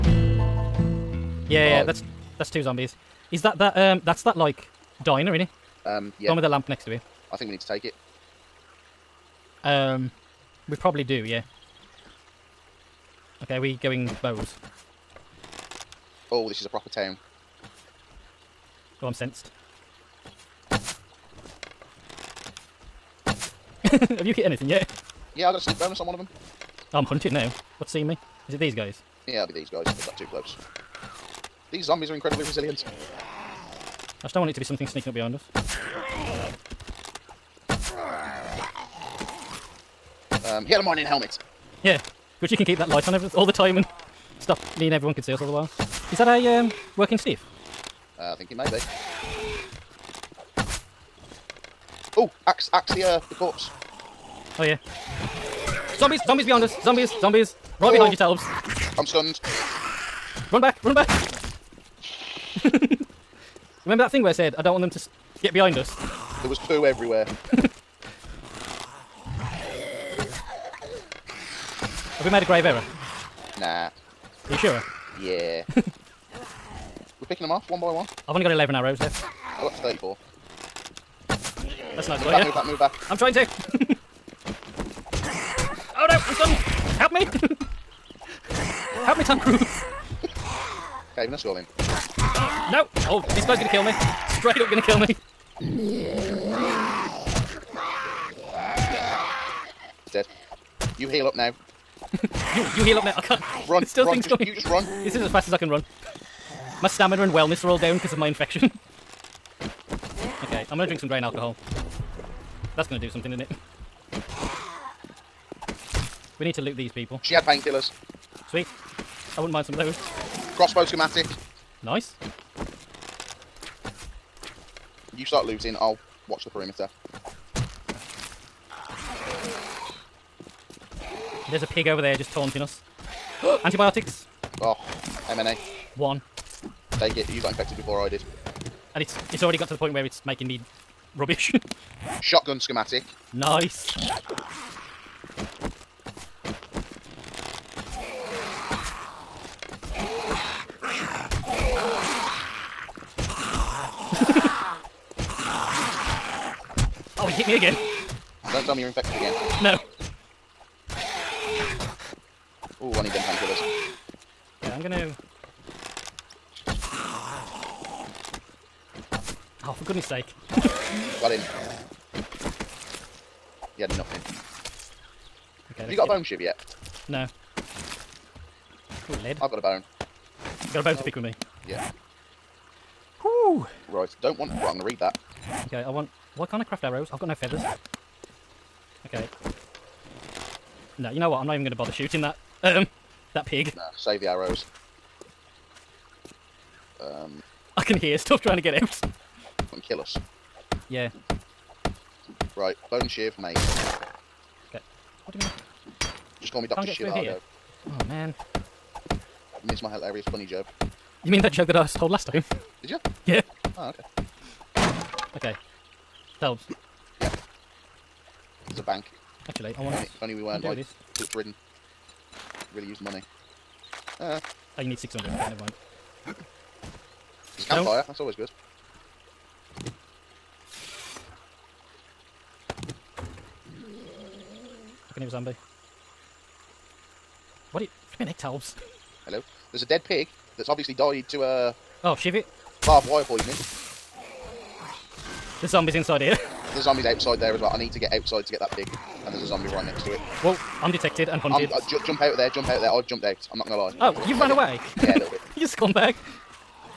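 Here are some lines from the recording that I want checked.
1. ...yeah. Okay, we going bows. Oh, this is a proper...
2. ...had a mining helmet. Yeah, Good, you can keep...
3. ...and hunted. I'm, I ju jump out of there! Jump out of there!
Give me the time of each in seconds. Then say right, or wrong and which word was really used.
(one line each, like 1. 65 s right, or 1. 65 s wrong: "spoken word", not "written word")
1. 11 s right
2. 40 s right
3. 251 s right.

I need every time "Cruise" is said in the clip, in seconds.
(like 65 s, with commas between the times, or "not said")
89 s.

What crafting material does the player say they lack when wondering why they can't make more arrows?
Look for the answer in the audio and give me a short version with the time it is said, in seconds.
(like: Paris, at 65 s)
Feathers, at 187 s.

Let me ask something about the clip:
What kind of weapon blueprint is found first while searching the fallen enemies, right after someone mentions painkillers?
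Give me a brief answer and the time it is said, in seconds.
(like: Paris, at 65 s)
Crossbow schematic, at 120 s.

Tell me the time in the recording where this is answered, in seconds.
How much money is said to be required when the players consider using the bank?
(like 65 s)
224 s.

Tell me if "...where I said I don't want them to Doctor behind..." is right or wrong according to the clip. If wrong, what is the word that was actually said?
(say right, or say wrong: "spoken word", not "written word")
wrong: "Get", not "Doctor".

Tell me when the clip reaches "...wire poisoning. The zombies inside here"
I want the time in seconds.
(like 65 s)
243 s.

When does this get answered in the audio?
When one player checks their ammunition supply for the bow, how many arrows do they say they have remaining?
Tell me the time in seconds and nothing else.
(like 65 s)
78 s.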